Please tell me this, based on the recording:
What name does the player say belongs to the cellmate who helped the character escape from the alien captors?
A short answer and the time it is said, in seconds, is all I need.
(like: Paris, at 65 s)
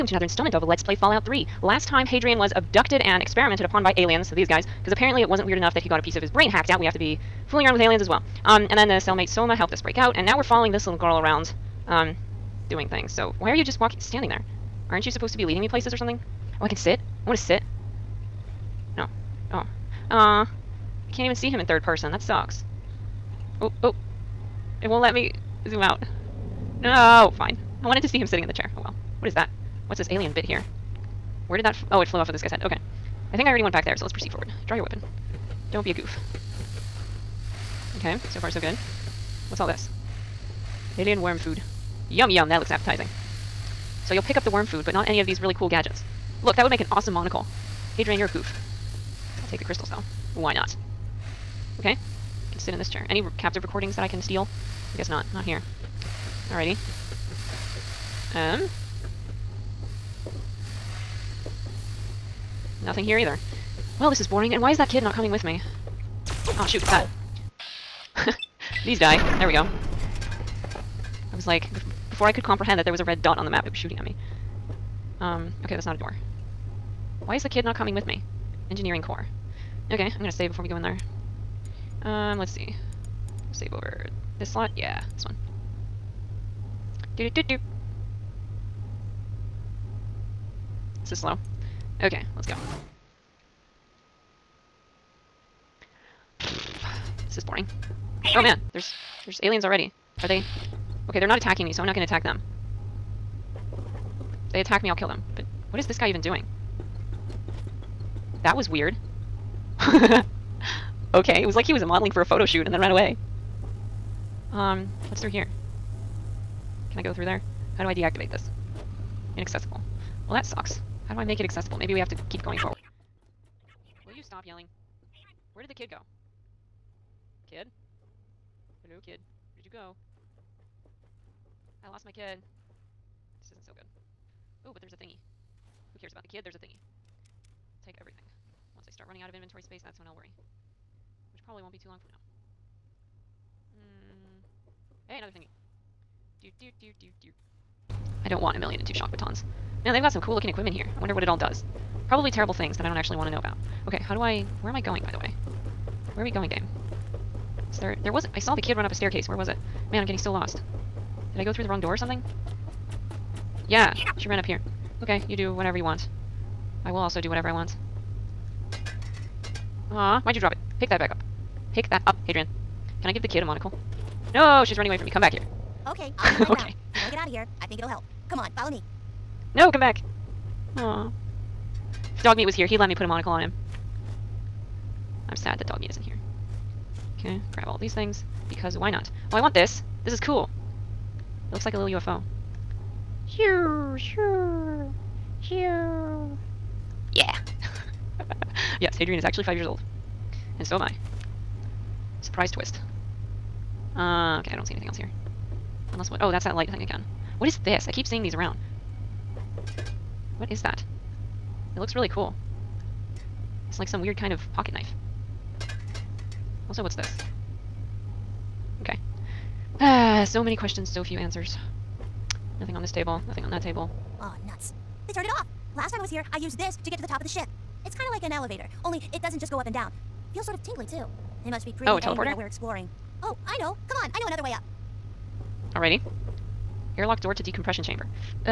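Somah, at 9 s.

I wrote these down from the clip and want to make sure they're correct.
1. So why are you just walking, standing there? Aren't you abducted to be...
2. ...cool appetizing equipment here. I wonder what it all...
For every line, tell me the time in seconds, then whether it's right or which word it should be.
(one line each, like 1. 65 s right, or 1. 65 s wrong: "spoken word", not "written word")
1. 13 s wrong: "supposed", not "abducted"
2. 150 s wrong: "looking", not "appetizing".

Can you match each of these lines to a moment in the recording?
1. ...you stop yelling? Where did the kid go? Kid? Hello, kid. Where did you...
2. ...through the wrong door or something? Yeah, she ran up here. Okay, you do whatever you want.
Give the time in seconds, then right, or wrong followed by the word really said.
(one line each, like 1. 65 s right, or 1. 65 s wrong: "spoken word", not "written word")
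1. 124 s right
2. 161 s right.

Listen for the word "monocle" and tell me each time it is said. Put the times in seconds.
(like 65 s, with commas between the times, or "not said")
47 s, 173 s, 183 s.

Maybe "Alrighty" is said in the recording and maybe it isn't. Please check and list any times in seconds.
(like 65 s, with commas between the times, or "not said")
56 s, 235 s.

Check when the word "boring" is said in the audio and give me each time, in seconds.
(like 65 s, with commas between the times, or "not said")
64 s, 97 s.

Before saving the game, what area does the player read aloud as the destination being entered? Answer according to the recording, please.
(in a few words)
Engineering core.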